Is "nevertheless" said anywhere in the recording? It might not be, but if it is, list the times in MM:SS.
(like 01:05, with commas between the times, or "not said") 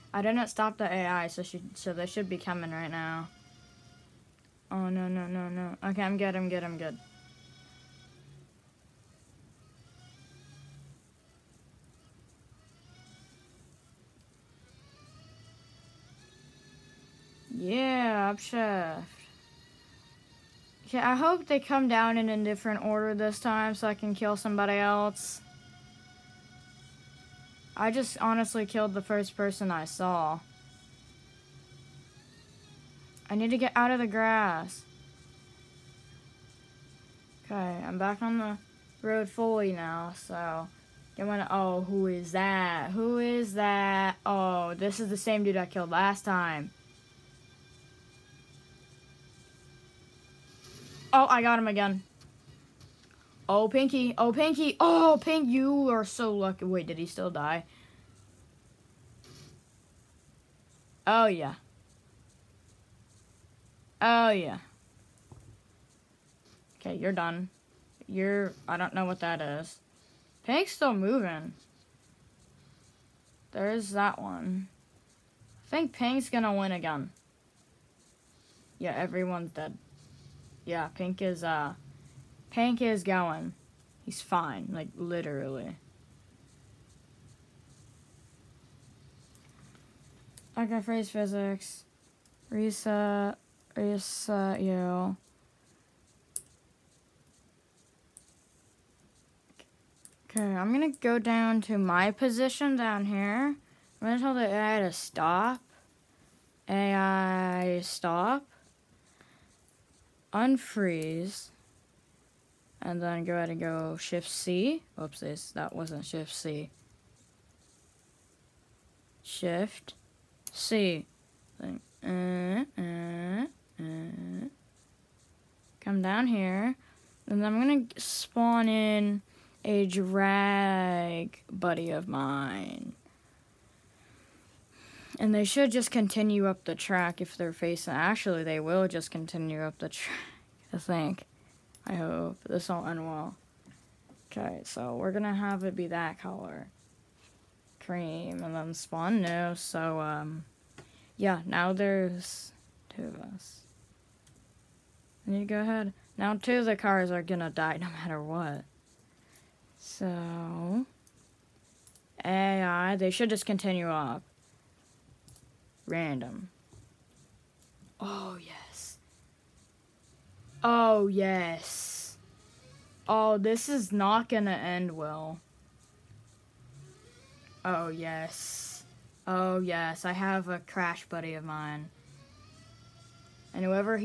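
not said.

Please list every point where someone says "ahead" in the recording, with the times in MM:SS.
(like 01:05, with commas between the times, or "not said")
01:53, 02:35.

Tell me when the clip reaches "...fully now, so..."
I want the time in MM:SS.
00:39.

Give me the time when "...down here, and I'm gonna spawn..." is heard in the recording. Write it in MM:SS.
02:06.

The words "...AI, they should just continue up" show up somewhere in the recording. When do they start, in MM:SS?
02:42.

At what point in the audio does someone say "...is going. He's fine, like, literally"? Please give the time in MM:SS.
01:22.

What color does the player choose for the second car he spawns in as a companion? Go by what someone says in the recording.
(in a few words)
Cream.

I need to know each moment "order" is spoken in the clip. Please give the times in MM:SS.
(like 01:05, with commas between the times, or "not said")
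00:22.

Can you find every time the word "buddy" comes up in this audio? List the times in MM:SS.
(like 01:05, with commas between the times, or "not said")
02:11, 03:01.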